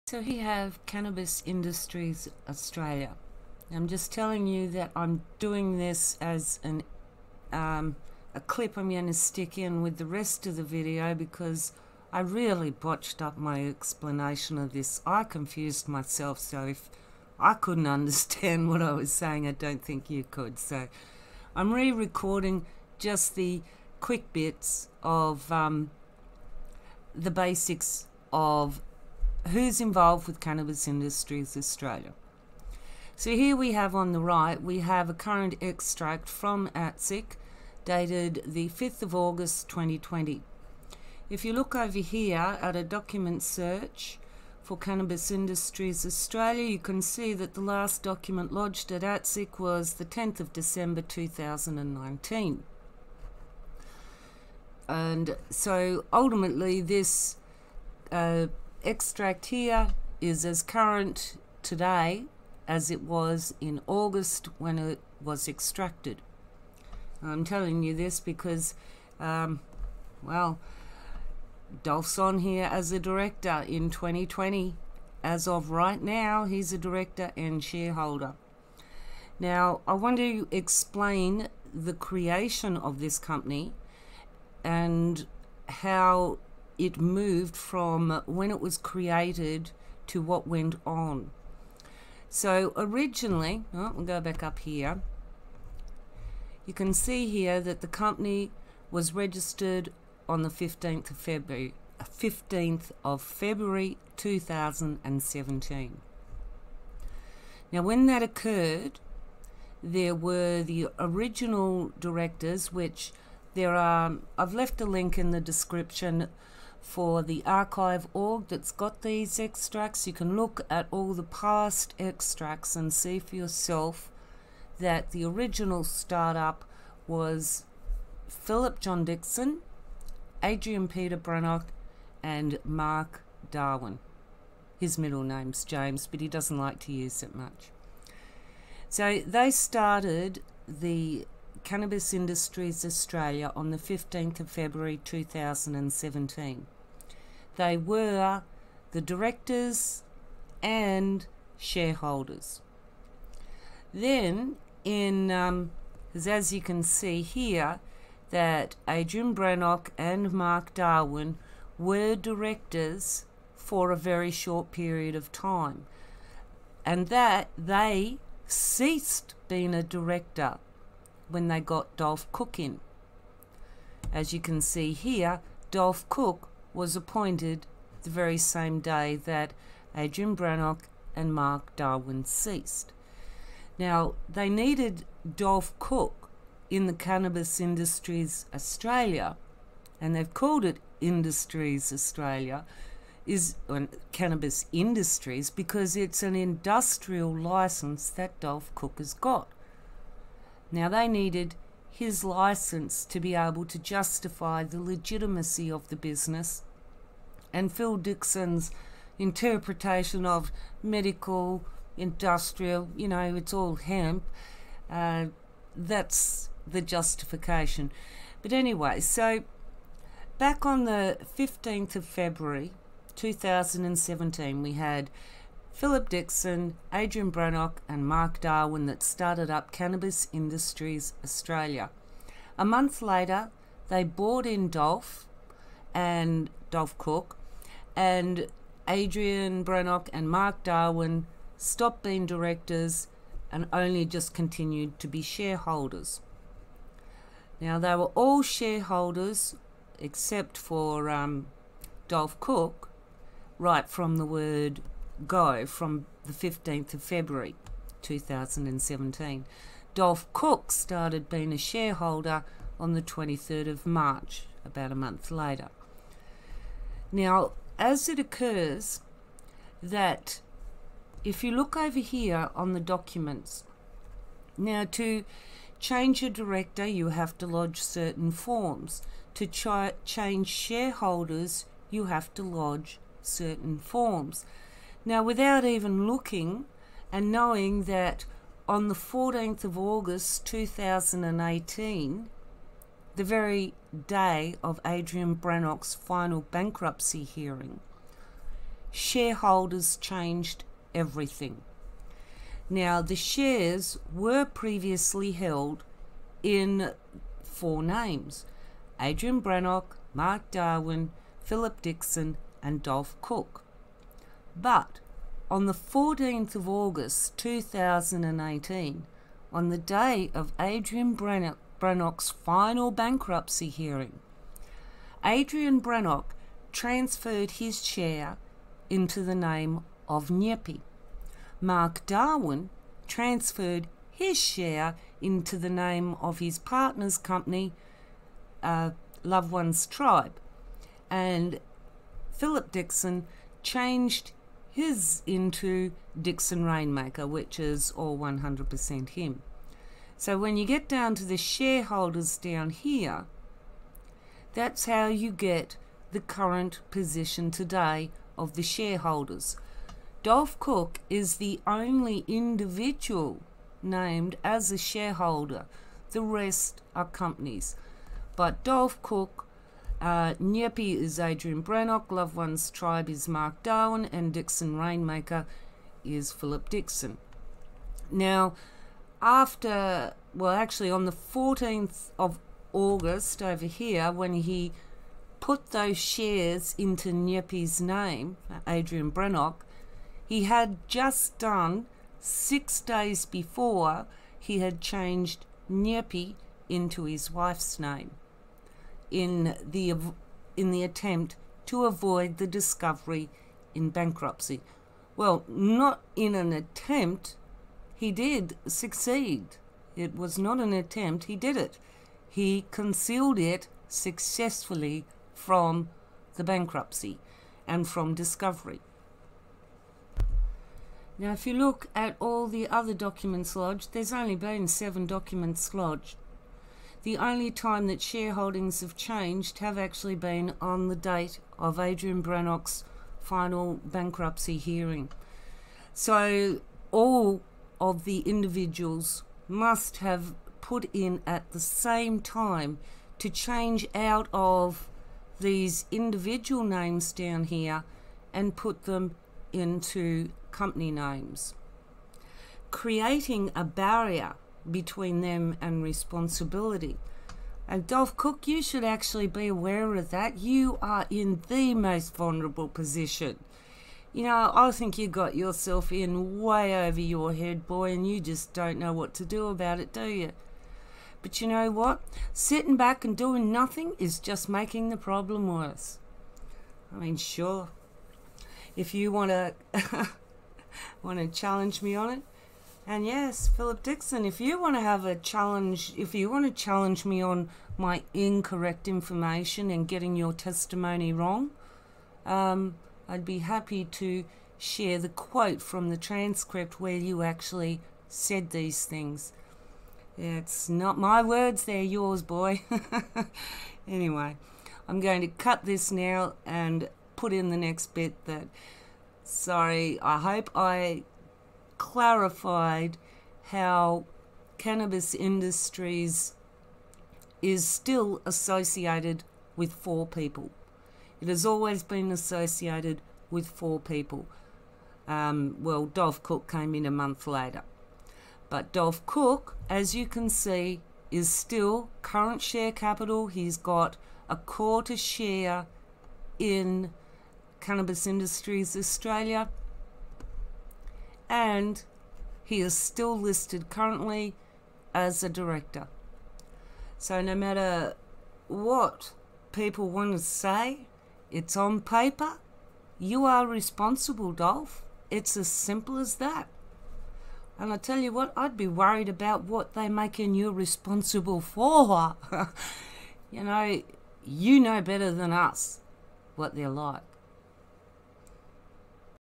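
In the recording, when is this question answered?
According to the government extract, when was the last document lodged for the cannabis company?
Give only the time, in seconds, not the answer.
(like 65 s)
50 s.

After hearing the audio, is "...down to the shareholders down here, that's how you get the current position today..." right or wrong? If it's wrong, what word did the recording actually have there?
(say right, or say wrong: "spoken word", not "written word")
right.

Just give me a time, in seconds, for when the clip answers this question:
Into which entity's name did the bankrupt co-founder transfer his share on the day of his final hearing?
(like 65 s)
330 s.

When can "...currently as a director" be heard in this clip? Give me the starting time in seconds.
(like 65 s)
543 s.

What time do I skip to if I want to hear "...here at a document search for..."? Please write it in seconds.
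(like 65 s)
41 s.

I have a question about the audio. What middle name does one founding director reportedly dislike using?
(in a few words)
James.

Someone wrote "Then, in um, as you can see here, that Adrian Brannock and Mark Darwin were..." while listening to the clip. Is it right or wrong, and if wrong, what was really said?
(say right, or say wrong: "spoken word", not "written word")
right.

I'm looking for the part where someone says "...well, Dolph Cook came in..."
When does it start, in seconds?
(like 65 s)
525 s.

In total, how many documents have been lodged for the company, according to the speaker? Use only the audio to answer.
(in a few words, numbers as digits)
7.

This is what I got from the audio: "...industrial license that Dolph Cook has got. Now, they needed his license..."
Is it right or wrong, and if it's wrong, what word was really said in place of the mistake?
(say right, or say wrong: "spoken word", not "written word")
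right.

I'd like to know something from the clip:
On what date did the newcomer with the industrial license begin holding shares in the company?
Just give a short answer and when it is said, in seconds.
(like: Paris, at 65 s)
23 March, at 263 s.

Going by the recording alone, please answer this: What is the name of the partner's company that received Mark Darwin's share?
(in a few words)
Loved Ones Tribe.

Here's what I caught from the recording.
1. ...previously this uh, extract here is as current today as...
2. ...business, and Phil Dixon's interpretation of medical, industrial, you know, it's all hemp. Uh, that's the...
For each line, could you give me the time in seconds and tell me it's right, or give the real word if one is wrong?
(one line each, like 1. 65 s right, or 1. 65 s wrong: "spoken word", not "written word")
1. 56 s wrong: "ultimately", not "previously"
2. 205 s right.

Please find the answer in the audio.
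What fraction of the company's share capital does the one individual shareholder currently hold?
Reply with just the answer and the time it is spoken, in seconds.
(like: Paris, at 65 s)
a quarter, at 534 s.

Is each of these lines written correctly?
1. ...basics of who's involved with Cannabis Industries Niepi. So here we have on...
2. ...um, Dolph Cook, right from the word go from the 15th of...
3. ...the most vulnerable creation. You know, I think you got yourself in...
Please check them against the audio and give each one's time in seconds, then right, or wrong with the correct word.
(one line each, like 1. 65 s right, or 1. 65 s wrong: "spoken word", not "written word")
1. 27 s wrong: "Australia", not "Niepi"
2. 251 s right
3. 461 s wrong: "position", not "creation".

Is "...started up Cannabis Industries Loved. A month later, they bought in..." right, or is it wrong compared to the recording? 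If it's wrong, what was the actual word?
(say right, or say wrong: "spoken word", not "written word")
wrong: "Australia", not "Loved".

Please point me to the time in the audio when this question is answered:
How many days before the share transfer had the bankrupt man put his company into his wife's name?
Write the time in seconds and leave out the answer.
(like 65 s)
392 s.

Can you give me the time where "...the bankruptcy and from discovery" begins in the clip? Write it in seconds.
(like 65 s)
416 s.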